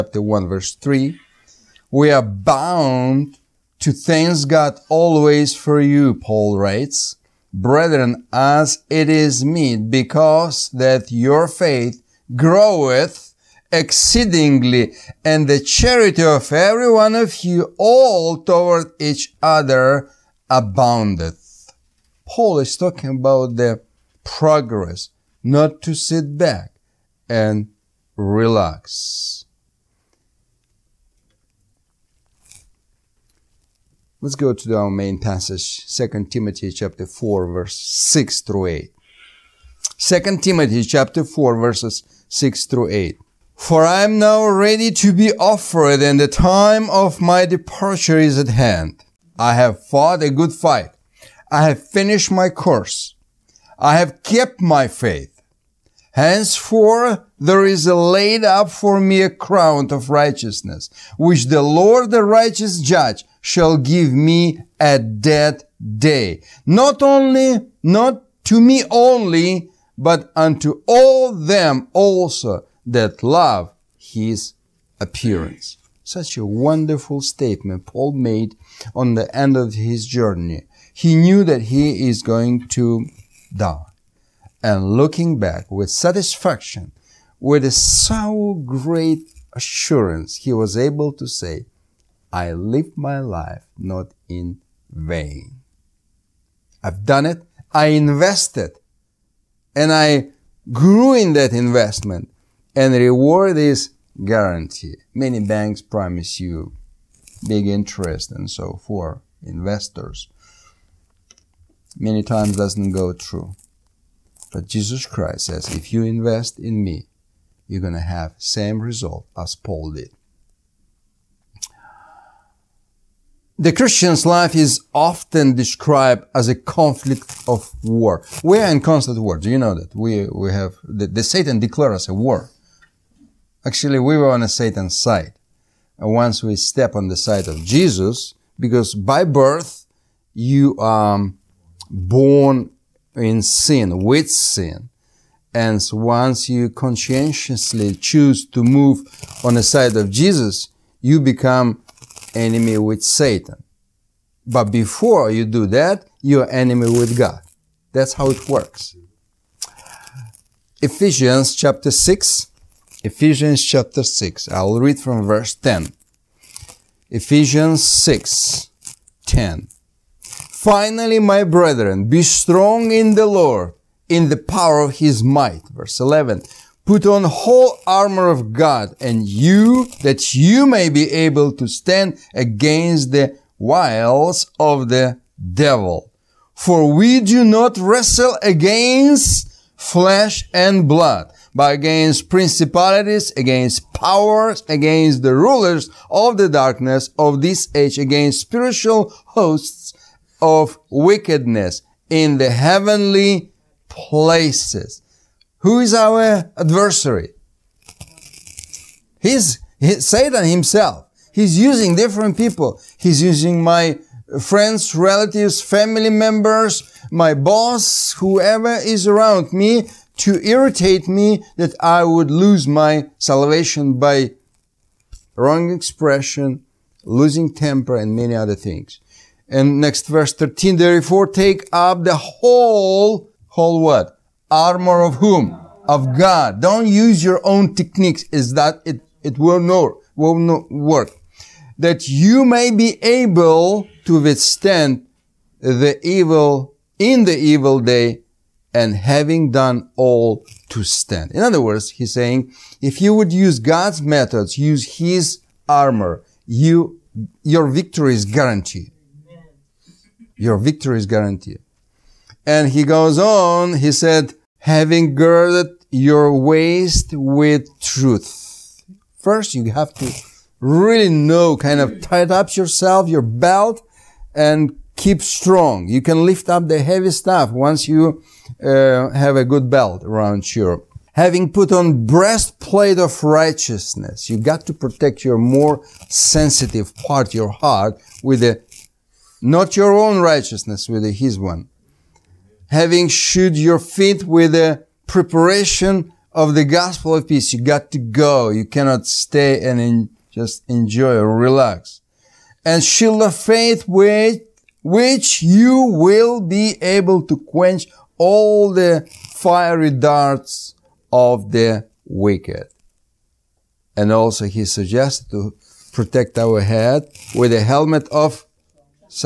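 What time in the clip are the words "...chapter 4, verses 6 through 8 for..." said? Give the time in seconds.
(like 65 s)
40 s.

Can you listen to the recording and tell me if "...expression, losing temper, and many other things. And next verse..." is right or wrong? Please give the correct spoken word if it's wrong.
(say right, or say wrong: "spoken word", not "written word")
right.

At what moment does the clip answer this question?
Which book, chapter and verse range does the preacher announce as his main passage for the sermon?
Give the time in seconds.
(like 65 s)
35 s.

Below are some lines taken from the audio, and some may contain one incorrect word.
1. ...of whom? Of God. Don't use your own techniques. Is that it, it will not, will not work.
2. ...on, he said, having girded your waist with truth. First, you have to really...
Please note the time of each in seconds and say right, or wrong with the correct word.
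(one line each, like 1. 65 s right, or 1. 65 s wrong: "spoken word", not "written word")
1. 235 s right
2. 263 s right.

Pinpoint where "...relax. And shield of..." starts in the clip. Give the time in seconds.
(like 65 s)
301 s.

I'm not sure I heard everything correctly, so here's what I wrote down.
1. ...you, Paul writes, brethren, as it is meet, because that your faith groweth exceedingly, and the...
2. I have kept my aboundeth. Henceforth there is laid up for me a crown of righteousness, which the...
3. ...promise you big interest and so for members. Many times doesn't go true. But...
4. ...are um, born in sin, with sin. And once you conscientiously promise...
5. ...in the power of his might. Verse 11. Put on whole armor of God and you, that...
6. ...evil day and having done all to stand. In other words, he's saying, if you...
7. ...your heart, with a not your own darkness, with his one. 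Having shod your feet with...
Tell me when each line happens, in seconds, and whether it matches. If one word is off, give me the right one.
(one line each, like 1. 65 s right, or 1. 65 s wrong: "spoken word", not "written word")
1. 5 s right
2. 53 s wrong: "faith", not "aboundeth"
3. 105 s wrong: "investors", not "members"
4. 140 s wrong: "choose", not "promise"
5. 174 s right
6. 247 s right
7. 287 s wrong: "righteousness", not "darkness".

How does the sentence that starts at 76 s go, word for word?
Such a wonderful statement Paul made on the end of his journey.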